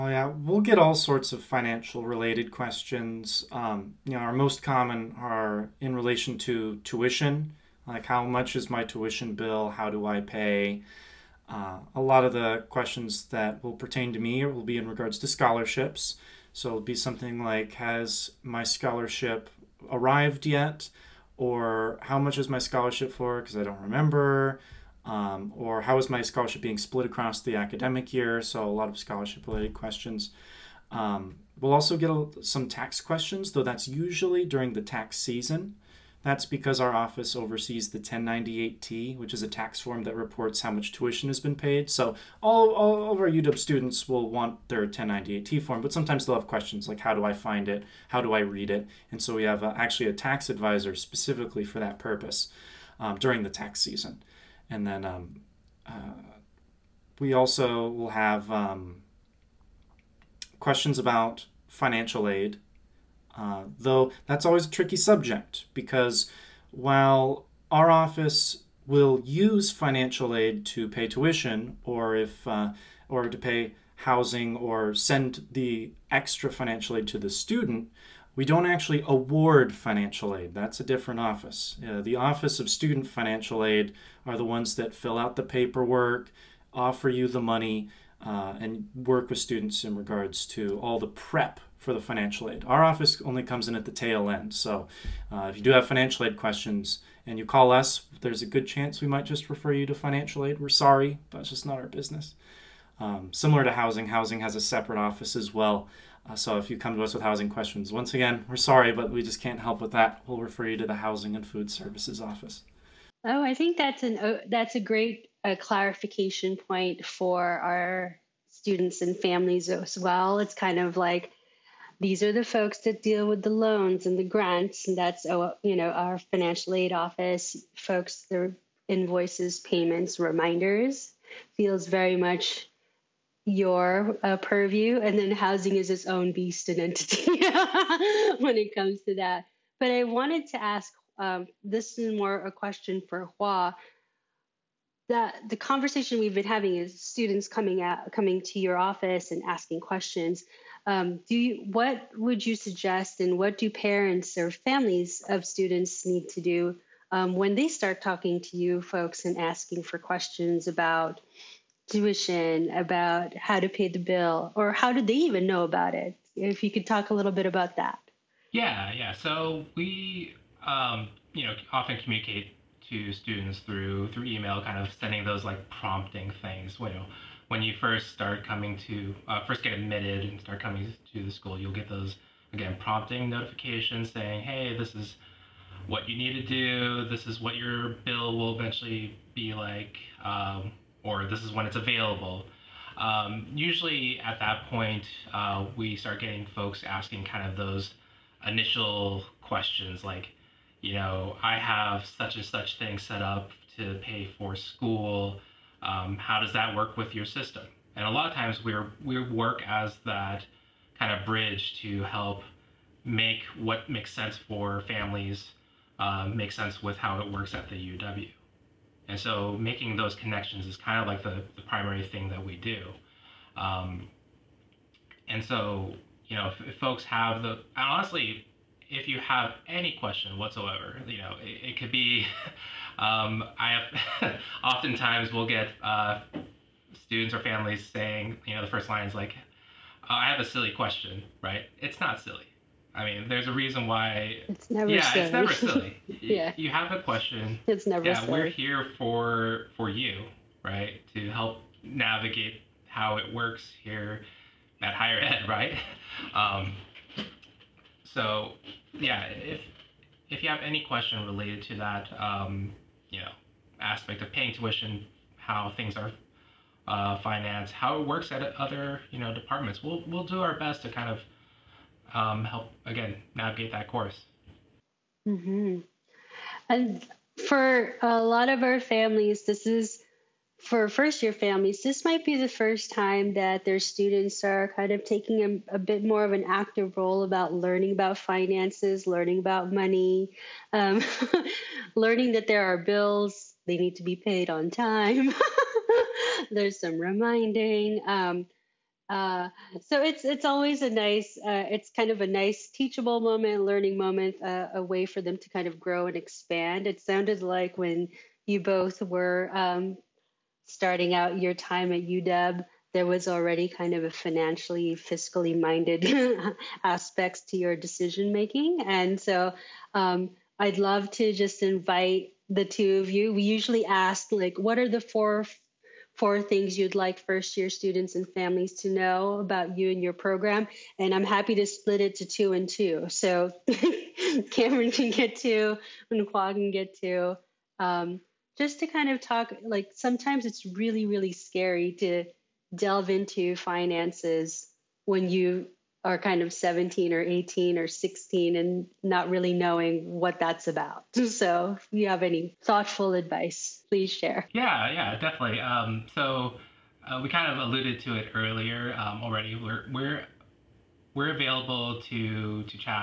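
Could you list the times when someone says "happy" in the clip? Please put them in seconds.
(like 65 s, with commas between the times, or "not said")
331 s.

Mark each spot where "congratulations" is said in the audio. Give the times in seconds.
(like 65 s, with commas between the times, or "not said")
not said.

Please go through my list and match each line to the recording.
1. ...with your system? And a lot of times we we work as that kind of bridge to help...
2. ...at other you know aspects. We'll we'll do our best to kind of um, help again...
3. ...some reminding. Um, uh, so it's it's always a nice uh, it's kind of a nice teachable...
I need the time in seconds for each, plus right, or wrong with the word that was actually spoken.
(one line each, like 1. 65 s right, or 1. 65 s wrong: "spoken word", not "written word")
1. 206 s right
2. 268 s wrong: "departments", not "aspects"
3. 296 s right.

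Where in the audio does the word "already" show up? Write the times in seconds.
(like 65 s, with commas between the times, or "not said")
313 s, 359 s.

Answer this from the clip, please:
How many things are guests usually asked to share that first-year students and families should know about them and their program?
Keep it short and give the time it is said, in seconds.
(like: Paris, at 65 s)
4, at 325 s.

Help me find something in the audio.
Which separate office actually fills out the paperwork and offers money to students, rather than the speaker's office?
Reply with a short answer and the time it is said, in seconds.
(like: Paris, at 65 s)
Office of Student Financial Aid, at 82 s.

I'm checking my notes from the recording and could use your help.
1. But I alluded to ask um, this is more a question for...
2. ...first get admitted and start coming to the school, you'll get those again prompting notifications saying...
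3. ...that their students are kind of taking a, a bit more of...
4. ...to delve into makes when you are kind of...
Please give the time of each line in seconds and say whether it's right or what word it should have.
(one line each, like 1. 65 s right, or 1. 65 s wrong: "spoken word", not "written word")
1. 139 s wrong: "wanted", not "alluded"
2. 179 s right
3. 283 s right
4. 341 s wrong: "finances", not "makes".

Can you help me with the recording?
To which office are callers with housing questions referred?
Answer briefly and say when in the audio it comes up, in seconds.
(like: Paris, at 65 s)
Housing and Food Services, at 110 s.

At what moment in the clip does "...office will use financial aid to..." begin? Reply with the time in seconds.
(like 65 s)
67 s.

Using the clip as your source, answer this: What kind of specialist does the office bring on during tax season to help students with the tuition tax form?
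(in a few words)
tax advisor.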